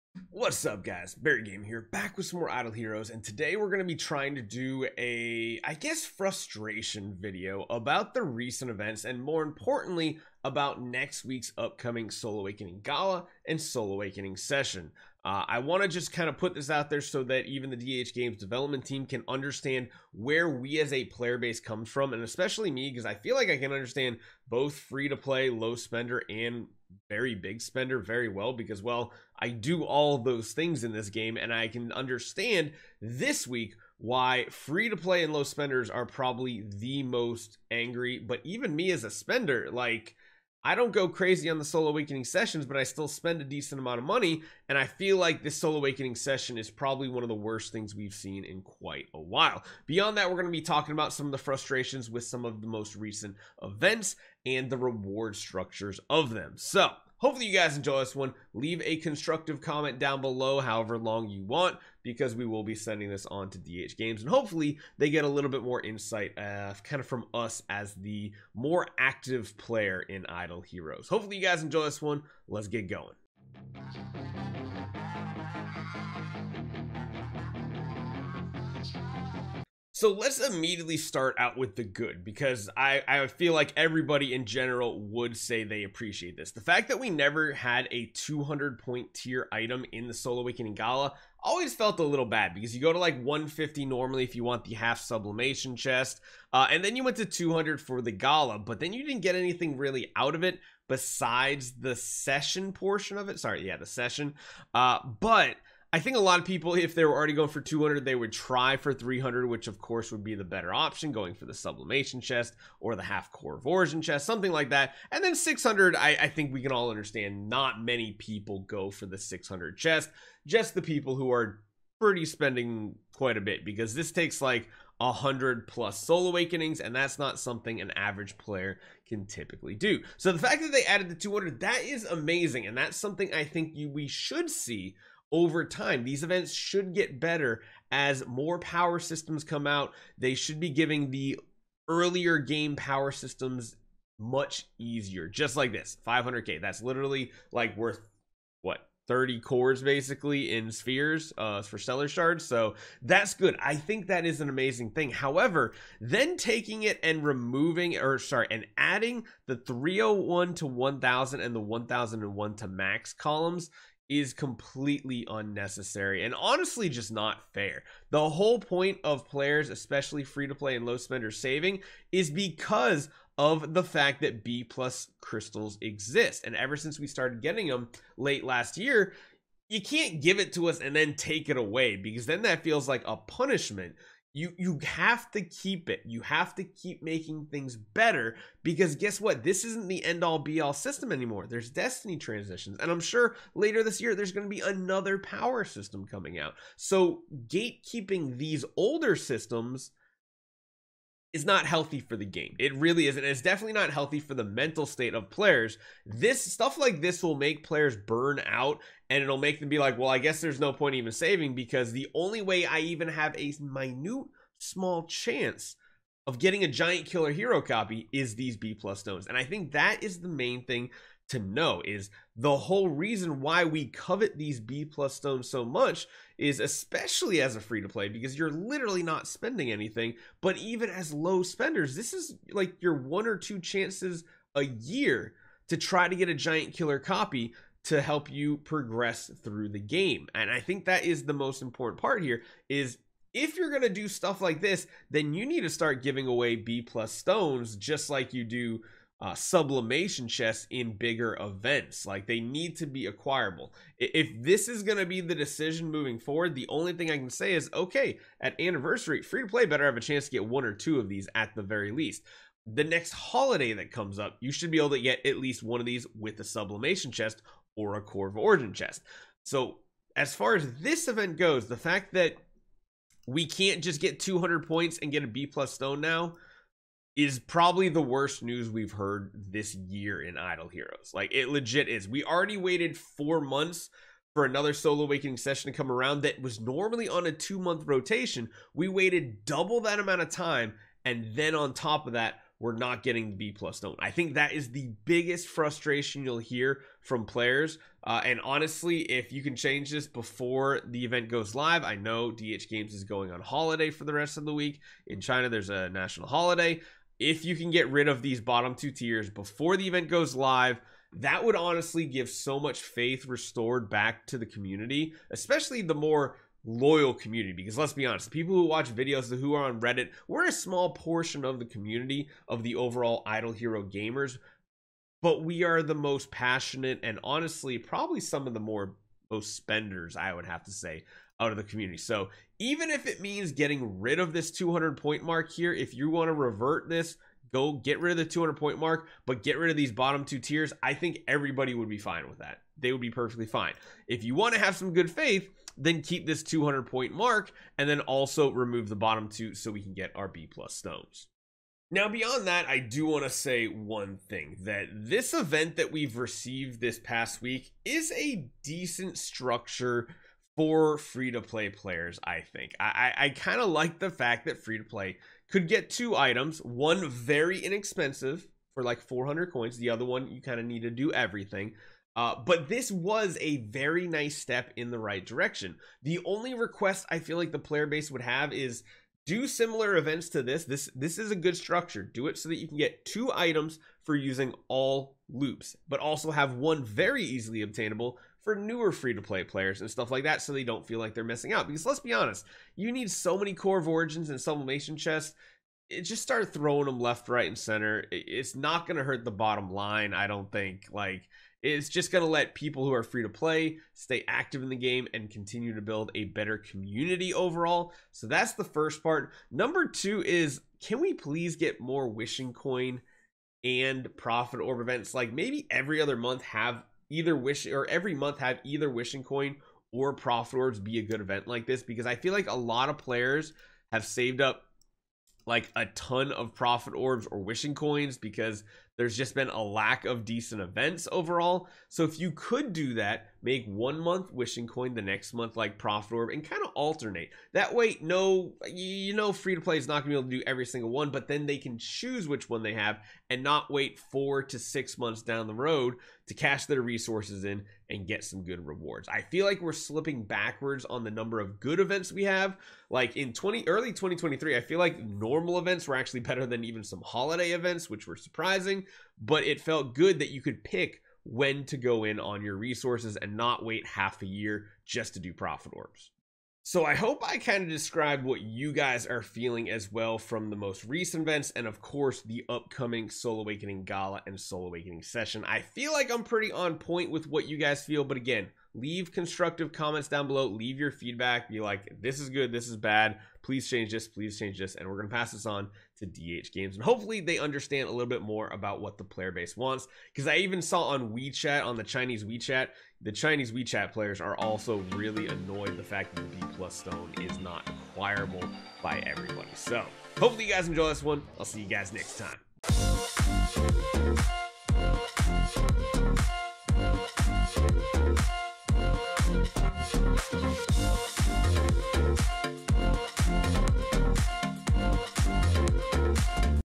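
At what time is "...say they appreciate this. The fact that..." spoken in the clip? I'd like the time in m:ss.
1:25.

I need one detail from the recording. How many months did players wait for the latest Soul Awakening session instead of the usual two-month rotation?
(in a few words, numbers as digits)
4 months.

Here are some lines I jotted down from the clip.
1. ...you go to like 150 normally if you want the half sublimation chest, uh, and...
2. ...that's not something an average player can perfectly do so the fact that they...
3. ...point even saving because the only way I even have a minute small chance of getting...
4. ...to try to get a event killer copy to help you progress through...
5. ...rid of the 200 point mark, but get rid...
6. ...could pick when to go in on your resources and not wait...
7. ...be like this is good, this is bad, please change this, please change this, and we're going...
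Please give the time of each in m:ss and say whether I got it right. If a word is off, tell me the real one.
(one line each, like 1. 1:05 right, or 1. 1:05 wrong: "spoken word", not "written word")
1. 1:32 right
2. 2:06 wrong: "typically", not "perfectly"
3. 3:30 right
4. 3:55 wrong: "giant", not "event"
5. 5:37 right
6. 7:40 right
7. 8:01 right.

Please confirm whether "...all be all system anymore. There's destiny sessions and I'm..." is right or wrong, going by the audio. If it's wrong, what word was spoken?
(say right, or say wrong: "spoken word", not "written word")
wrong: "transitions", not "sessions".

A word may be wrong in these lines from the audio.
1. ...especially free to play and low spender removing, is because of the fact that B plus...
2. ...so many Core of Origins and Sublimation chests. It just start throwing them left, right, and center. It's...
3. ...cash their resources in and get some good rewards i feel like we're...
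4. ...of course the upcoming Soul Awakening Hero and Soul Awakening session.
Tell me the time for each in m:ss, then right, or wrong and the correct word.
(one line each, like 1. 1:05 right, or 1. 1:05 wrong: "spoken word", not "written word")
1. 2:49 wrong: "saving", not "removing"
2. 6:33 right
3. 7:26 right
4. 7:51 wrong: "Gala", not "Hero".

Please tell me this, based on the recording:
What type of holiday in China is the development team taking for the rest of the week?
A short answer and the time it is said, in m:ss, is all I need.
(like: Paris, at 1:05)
national holiday, at 5:05.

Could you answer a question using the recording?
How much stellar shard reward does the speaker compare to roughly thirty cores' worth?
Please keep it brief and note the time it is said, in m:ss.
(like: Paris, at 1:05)
500k, at 2:26.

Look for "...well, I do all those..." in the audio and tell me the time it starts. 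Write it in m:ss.
0:28.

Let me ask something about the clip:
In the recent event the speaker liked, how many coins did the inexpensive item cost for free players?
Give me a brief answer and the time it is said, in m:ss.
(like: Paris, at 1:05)
400, at 6:09.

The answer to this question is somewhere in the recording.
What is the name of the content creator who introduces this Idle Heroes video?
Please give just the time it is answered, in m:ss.
0:01.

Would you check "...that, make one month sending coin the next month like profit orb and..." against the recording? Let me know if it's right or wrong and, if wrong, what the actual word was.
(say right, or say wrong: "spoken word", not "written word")
wrong: "wishing", not "sending".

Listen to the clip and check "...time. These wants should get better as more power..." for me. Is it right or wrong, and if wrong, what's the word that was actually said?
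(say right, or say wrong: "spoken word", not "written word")
wrong: "events", not "wants".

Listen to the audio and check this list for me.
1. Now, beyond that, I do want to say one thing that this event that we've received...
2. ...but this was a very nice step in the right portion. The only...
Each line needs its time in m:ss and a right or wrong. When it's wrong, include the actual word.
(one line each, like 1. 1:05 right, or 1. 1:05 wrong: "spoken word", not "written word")
1. 5:51 right
2. 6:12 wrong: "direction", not "portion".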